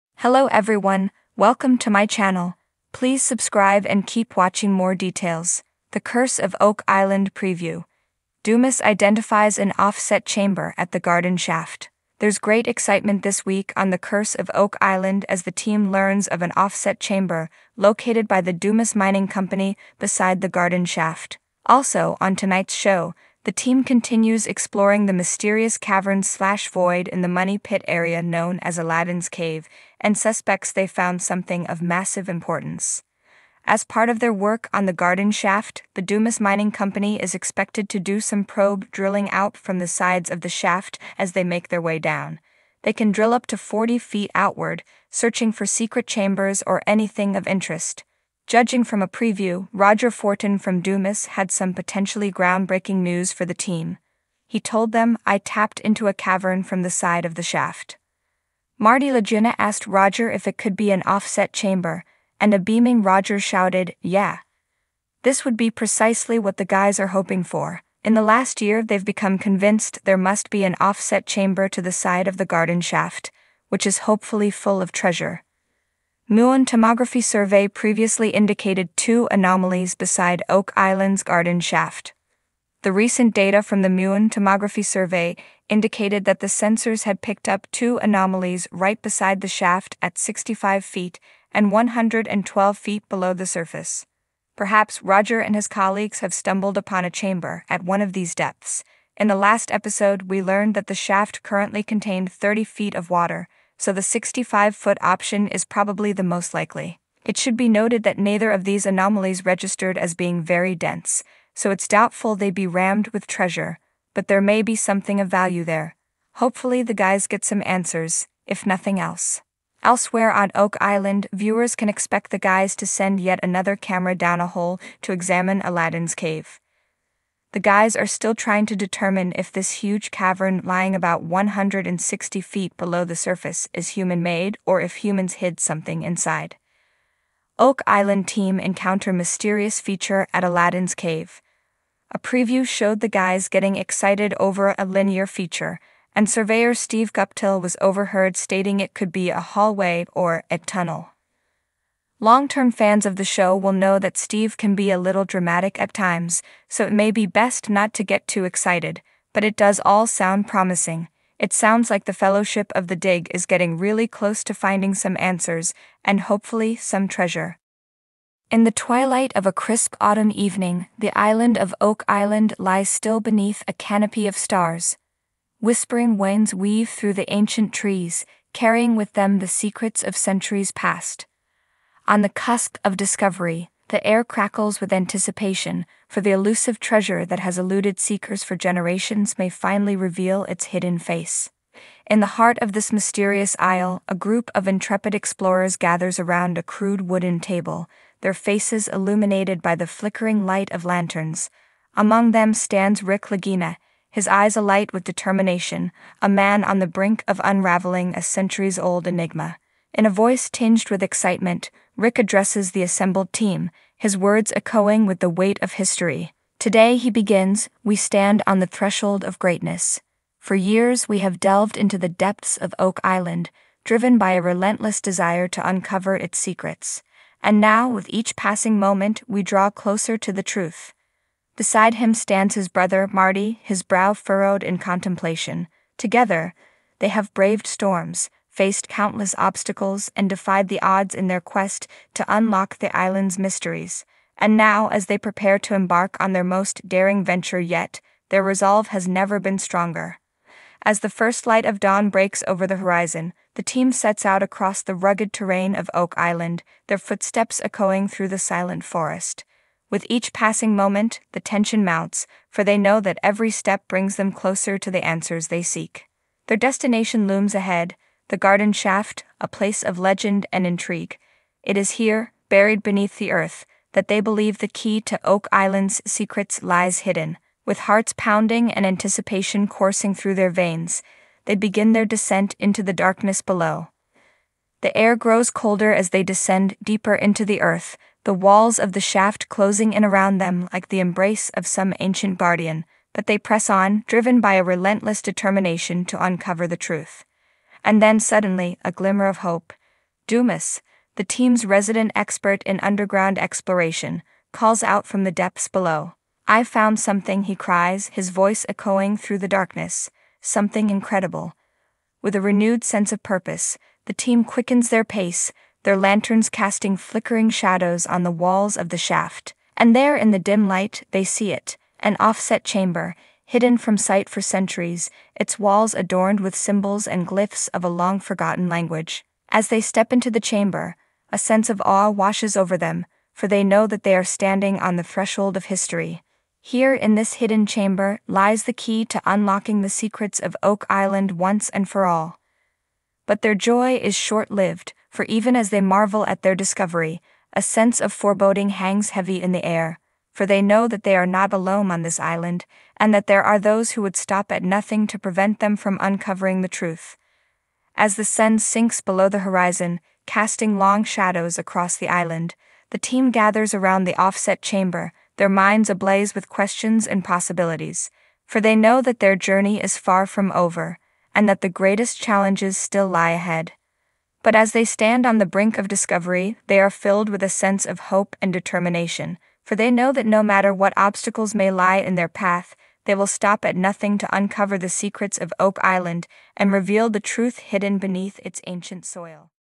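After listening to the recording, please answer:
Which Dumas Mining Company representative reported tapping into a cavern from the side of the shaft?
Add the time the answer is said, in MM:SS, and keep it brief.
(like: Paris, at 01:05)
Roger Fortin, at 00:49.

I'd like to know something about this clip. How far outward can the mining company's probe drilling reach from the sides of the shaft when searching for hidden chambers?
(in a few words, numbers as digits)
40 feet.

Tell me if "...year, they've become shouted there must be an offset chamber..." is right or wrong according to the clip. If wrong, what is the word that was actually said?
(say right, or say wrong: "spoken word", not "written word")
wrong: "convinced", not "shouted".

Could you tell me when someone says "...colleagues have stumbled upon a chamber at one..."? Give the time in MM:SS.
01:35.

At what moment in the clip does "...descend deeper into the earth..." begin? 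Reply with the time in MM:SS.
04:46.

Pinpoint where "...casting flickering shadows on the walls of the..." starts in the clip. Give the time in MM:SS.
05:16.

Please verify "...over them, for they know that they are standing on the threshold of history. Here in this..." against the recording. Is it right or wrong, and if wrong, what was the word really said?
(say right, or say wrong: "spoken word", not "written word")
right.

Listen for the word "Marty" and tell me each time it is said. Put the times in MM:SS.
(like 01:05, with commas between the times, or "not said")
00:58, 03:53.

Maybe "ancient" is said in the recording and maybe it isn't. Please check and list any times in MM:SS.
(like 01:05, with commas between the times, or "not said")
02:57, 04:51, 06:28.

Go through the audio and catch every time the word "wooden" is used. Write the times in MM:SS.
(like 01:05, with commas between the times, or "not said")
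03:17.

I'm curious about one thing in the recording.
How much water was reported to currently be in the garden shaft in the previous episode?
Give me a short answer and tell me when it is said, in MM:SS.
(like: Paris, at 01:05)
30 feet, at 01:42.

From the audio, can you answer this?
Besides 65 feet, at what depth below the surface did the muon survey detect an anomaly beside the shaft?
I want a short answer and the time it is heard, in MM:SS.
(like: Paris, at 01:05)
112 feet, at 01:31.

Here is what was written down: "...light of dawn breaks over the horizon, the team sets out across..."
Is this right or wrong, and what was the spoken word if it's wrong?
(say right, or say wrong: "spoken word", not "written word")
right.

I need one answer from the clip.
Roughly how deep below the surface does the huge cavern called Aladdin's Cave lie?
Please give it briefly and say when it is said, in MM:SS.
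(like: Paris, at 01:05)
160 feet, at 02:11.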